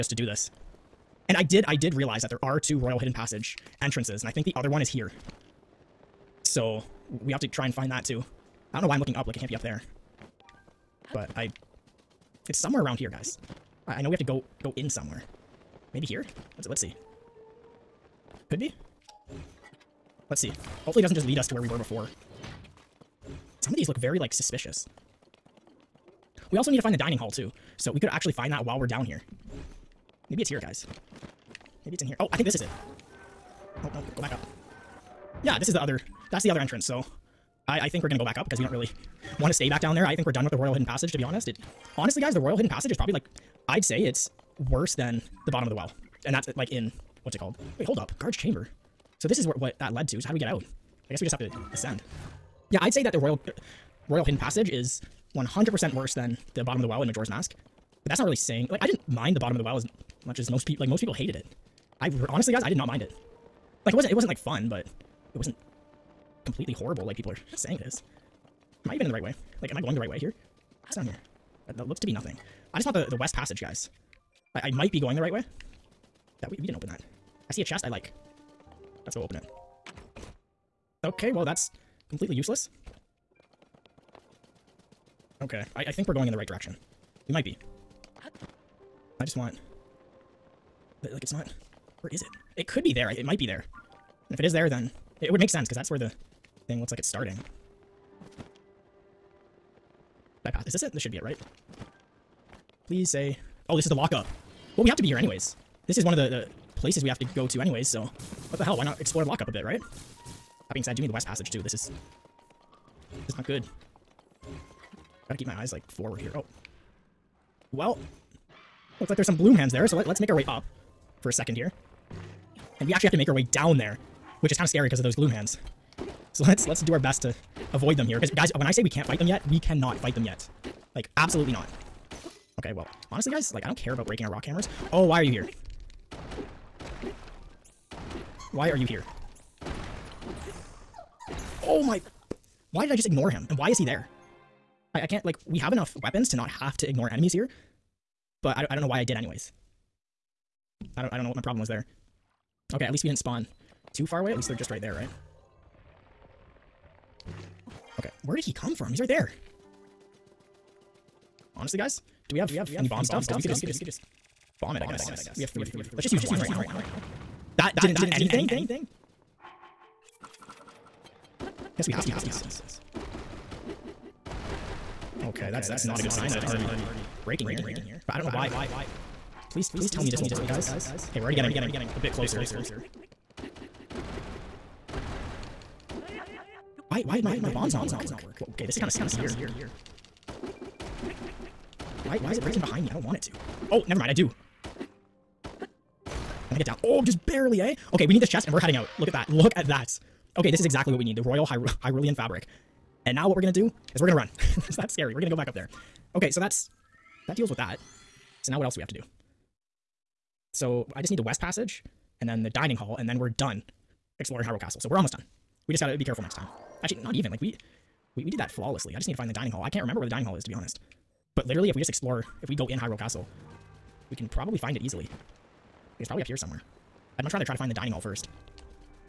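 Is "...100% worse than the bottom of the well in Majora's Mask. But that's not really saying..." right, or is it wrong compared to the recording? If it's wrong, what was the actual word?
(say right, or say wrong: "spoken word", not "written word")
right.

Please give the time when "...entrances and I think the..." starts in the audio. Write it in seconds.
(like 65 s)
3 s.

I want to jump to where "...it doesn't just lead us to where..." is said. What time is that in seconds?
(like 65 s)
21 s.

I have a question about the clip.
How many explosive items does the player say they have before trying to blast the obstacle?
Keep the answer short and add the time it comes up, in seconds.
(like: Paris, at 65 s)
3, at 165 s.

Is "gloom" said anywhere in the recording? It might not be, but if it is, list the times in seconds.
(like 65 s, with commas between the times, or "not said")
119 s, 125 s.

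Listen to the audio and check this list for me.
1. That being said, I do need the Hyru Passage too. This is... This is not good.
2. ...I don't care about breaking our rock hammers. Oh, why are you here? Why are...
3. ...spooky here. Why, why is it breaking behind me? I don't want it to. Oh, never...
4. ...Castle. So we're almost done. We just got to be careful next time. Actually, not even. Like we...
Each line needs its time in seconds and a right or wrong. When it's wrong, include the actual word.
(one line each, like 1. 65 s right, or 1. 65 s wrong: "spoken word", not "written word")
1. 110 s wrong: "West", not "Hyru"
2. 133 s right
3. 188 s right
4. 214 s right.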